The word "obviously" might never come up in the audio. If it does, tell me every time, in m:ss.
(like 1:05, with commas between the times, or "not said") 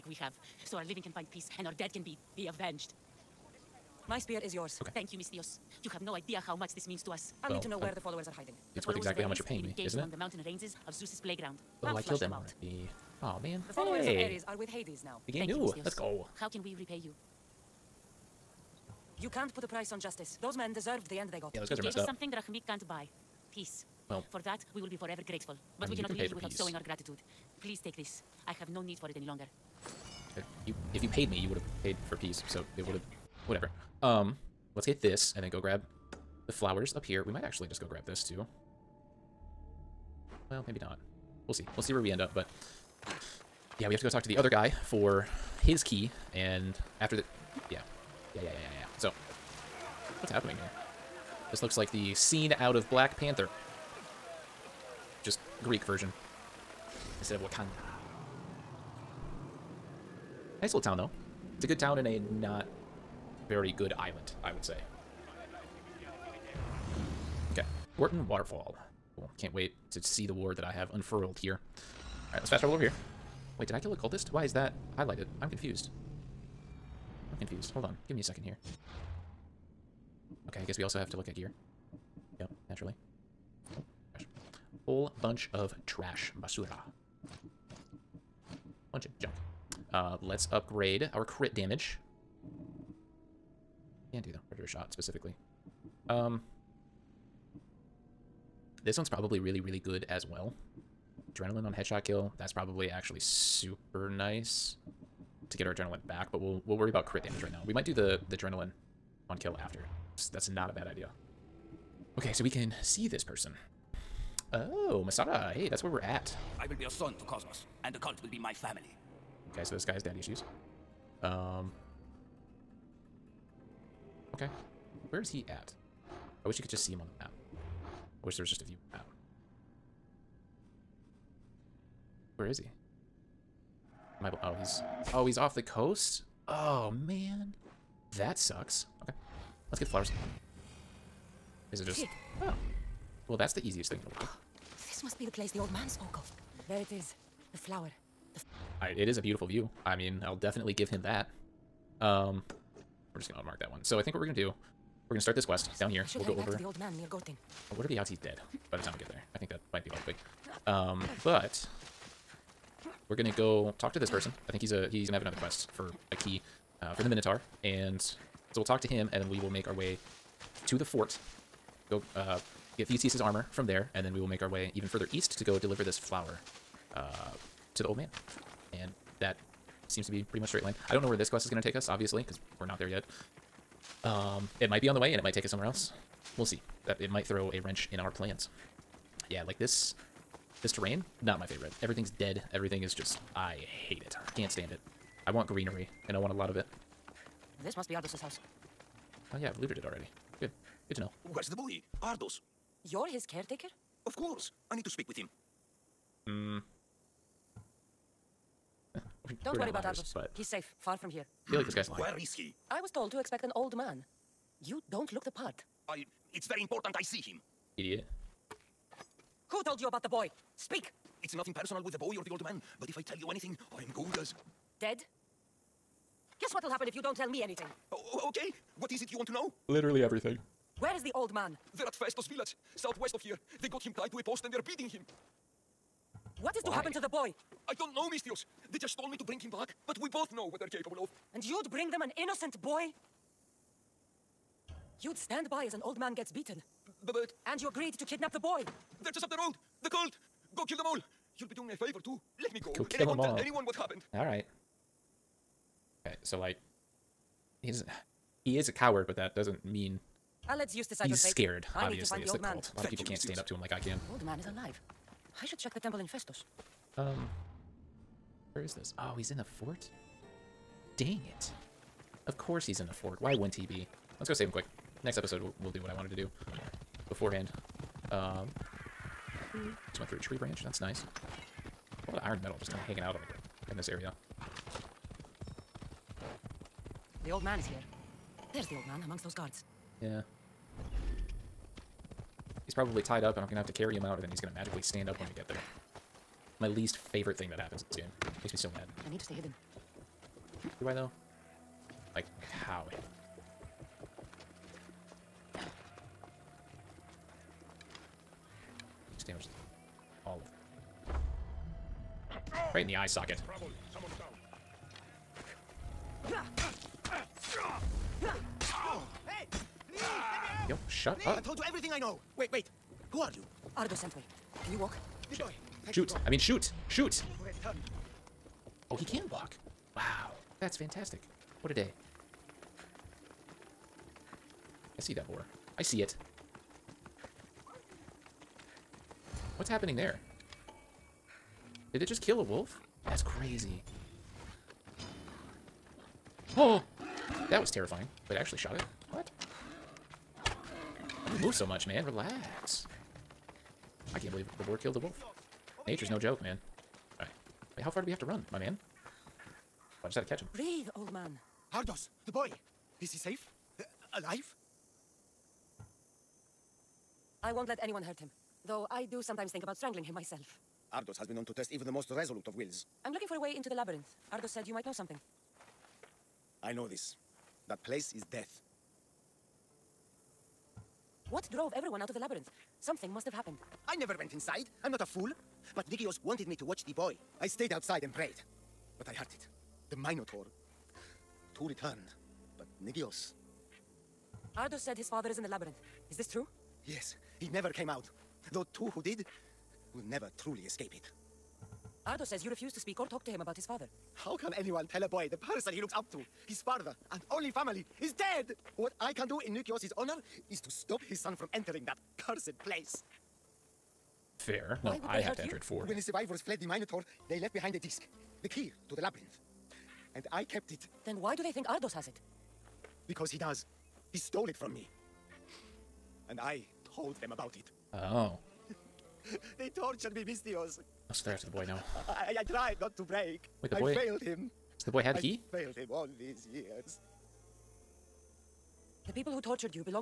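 3:01, 4:21.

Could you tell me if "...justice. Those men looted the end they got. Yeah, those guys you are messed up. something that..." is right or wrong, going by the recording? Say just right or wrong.
wrong.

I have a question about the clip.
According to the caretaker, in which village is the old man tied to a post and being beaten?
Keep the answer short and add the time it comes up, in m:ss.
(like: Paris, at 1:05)
Phaistos, at 3:51.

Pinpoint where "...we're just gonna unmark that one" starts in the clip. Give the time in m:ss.
2:33.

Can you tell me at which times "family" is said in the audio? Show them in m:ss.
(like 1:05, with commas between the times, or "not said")
1:58, 6:47.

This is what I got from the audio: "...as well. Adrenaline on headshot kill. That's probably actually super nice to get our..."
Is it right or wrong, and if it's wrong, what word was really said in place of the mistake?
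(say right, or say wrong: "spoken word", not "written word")
right.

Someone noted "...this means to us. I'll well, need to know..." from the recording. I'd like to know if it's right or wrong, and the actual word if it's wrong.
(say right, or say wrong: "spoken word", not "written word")
right.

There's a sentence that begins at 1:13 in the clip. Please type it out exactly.
Wait, did I kill a cultist?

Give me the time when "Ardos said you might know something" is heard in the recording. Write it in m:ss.
6:14.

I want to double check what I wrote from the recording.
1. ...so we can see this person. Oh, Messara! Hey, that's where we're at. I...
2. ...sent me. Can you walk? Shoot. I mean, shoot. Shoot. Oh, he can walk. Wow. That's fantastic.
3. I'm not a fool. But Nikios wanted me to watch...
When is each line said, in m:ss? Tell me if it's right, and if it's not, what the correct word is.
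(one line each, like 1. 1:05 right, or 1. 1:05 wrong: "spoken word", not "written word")
1. 1:52 right
2. 5:23 right
3. 6:24 right.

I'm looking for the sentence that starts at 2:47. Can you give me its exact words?
And so we'll talk to him, and then we will make our way to the fort.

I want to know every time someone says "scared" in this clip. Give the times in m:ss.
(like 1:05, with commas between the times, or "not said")
4:21.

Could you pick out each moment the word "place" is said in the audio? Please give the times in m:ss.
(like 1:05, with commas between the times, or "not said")
2:25, 6:17, 6:52.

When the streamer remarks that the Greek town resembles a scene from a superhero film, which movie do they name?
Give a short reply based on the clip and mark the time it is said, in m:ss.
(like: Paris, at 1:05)
Black Panther, at 0:52.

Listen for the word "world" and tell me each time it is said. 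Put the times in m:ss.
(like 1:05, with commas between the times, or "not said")
2:24.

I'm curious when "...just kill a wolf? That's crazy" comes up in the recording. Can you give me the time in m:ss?
5:42.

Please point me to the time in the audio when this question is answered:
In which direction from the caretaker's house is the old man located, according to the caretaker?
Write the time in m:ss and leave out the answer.
3:52.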